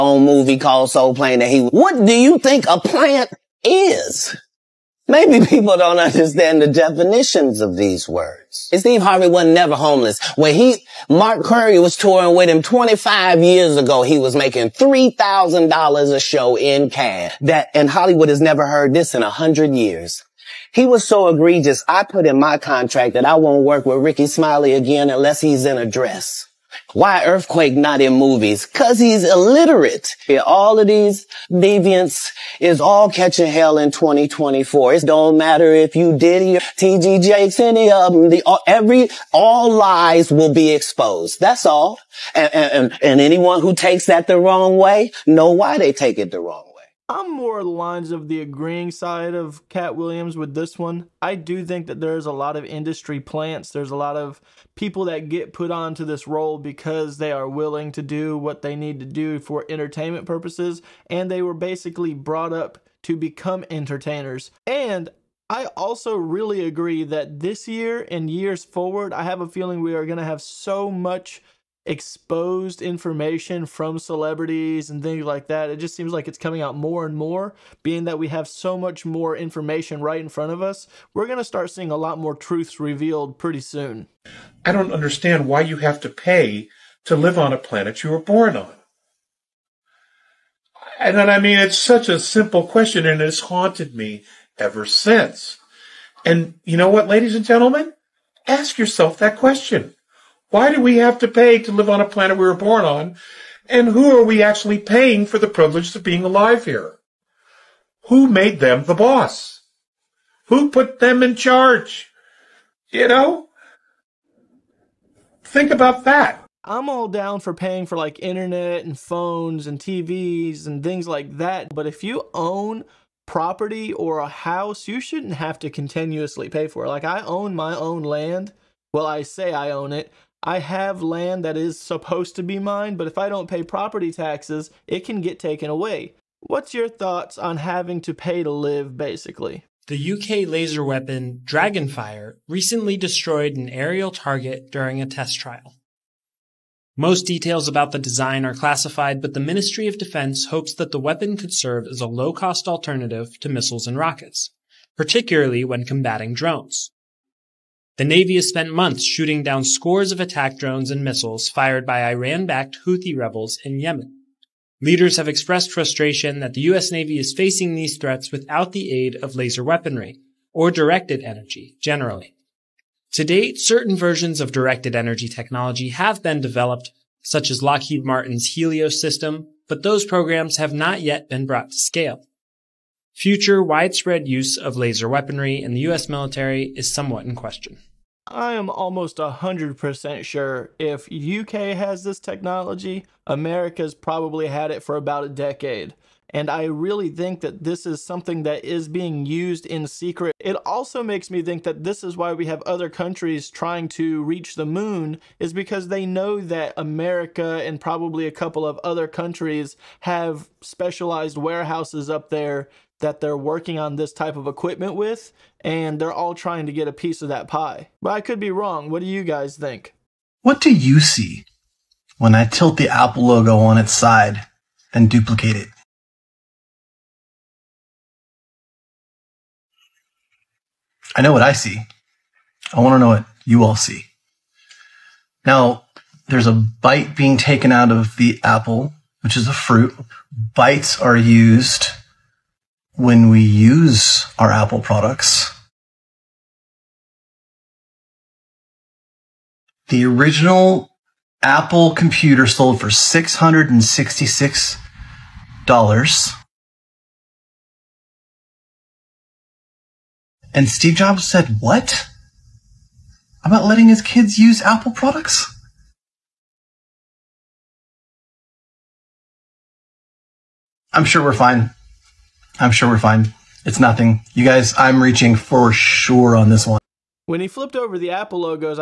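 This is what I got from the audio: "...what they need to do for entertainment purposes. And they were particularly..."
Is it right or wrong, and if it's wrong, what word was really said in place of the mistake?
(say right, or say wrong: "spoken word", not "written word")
wrong: "basically", not "particularly".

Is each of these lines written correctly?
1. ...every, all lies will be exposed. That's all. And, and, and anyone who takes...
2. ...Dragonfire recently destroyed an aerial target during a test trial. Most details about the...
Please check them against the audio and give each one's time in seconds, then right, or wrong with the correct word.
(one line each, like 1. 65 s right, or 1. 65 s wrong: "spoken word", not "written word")
1. 38 s right
2. 141 s right.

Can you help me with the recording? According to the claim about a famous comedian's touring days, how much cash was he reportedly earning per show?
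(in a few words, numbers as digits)
$3,000.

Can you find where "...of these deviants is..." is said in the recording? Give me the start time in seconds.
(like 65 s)
30 s.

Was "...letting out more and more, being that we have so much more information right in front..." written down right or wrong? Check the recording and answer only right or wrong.
wrong.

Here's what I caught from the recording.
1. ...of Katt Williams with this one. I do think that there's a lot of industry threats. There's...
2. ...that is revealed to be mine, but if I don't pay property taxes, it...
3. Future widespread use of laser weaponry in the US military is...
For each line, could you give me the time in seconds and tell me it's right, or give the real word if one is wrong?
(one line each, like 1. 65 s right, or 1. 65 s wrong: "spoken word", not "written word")
1. 49 s wrong: "plants", not "threats"
2. 131 s wrong: "supposed", not "revealed"
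3. 183 s right.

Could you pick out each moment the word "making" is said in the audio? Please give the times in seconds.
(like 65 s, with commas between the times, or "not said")
14 s.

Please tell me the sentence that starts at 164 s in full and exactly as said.
Leaders have expressed frustration that the U.S.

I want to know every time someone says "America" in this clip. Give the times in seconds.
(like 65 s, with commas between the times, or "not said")
193 s, 206 s.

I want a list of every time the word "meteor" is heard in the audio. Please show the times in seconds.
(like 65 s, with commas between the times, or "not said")
not said.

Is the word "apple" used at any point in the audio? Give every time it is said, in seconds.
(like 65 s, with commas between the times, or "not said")
222 s, 238 s, 244 s, 251 s, 264 s, 278 s.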